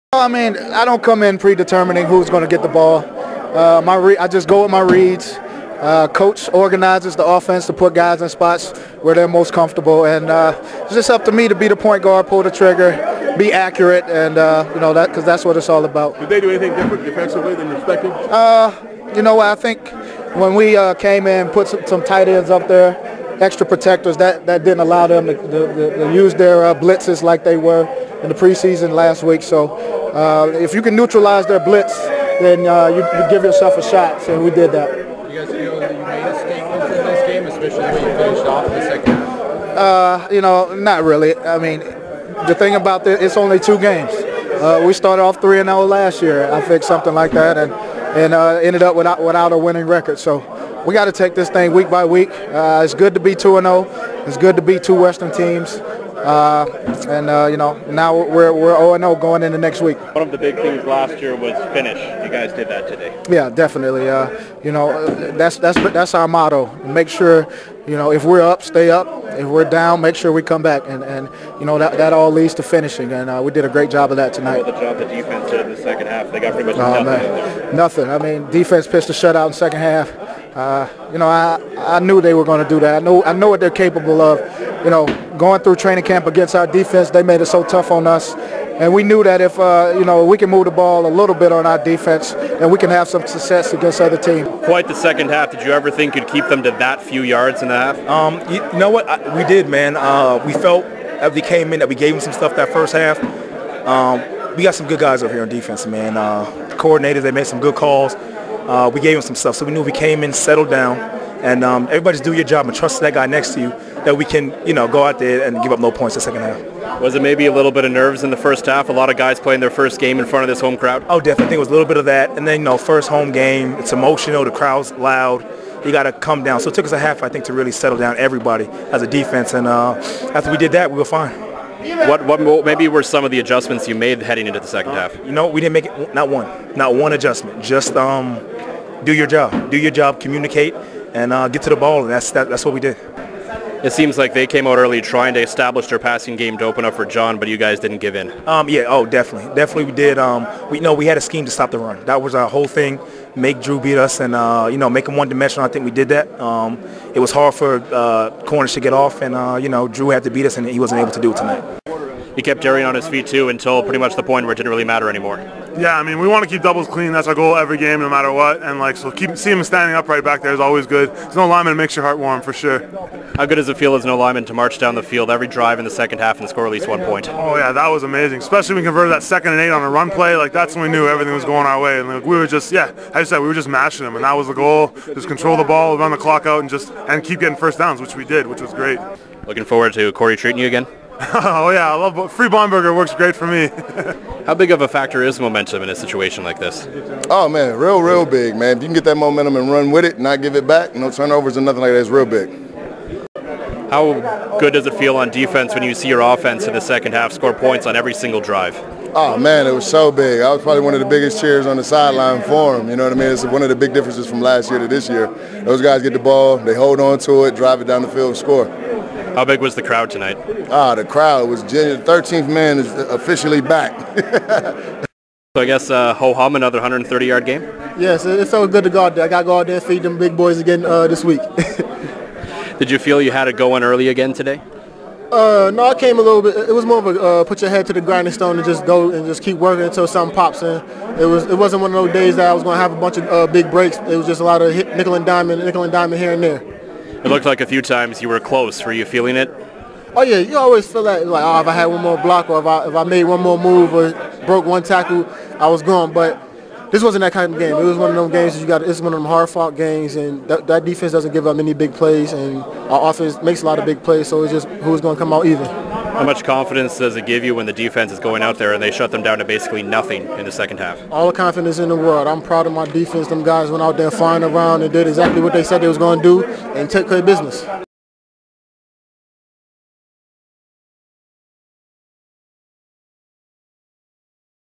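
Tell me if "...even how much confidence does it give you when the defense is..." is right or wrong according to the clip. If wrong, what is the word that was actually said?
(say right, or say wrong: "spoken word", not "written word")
right.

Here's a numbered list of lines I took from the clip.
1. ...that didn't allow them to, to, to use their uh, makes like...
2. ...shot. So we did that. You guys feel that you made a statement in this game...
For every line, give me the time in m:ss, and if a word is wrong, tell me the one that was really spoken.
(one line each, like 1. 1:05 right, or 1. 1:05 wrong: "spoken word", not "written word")
1. 0:24 wrong: "blitzes", not "makes"
2. 0:33 right.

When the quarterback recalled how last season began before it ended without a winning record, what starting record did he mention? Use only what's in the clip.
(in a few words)
3 and 0.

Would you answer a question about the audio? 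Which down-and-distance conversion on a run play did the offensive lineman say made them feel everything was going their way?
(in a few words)
second and eight.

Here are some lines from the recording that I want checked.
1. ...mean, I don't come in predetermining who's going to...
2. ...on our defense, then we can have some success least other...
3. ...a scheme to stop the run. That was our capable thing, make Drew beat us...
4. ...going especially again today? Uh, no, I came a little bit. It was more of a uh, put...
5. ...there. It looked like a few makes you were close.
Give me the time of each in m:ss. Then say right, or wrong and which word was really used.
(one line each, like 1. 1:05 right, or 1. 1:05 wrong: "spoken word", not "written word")
1. 0:00 right
2. 1:31 wrong: "against", not "least"
3. 2:31 wrong: "whole", not "capable"
4. 3:53 wrong: "early", not "especially"
5. 4:06 wrong: "times", not "makes".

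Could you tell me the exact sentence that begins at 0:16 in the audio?
Did they do anything different defensively than you expected?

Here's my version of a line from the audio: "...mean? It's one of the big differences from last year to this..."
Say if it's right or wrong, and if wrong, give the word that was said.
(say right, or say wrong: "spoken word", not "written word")
right.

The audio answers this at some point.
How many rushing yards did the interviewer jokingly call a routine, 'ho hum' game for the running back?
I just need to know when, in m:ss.
3:46.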